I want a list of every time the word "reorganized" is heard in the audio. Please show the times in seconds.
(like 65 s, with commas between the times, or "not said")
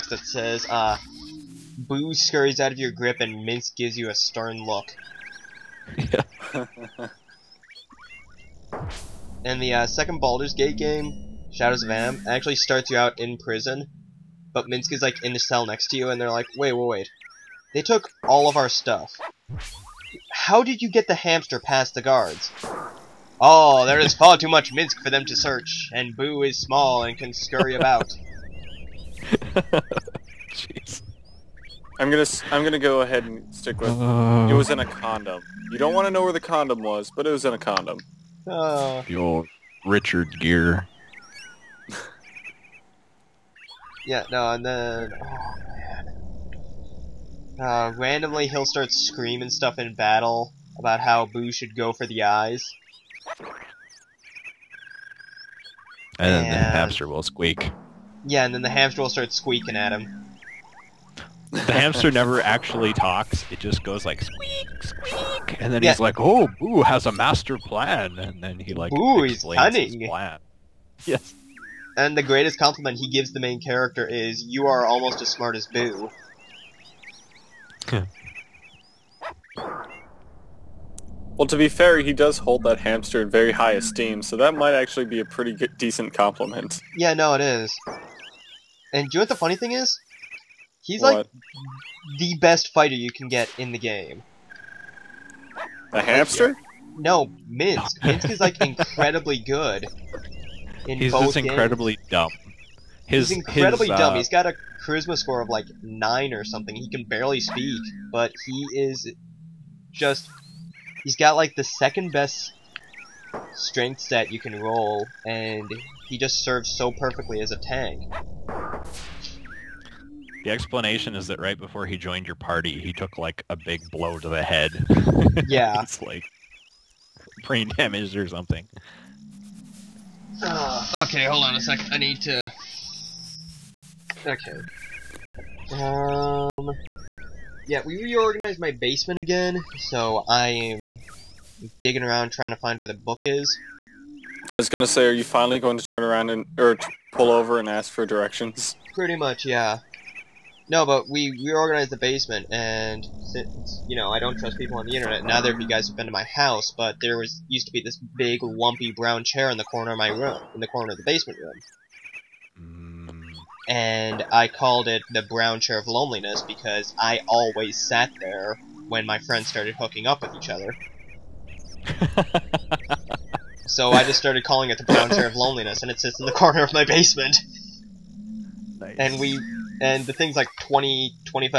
138 s, 151 s.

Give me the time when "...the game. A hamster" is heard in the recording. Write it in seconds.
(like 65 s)
93 s.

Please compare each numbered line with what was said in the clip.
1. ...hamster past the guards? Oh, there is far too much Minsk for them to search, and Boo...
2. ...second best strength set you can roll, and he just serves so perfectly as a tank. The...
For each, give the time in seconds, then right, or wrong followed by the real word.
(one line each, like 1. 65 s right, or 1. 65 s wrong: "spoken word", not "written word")
1. 21 s right
2. 111 s right.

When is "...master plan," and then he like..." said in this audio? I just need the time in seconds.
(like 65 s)
67 s.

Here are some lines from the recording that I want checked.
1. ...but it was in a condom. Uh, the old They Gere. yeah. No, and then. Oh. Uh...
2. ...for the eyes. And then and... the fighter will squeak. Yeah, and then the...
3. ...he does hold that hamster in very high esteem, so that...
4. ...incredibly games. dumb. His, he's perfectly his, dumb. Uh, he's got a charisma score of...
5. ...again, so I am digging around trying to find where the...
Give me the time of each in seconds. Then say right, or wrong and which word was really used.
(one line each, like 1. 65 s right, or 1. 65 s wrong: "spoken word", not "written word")
1. 37 s wrong: "Richard", not "They"
2. 51 s wrong: "hamster", not "fighter"
3. 81 s right
4. 101 s wrong: "incredibly", not "perfectly"
5. 139 s right.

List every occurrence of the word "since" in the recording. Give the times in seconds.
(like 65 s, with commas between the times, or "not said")
153 s.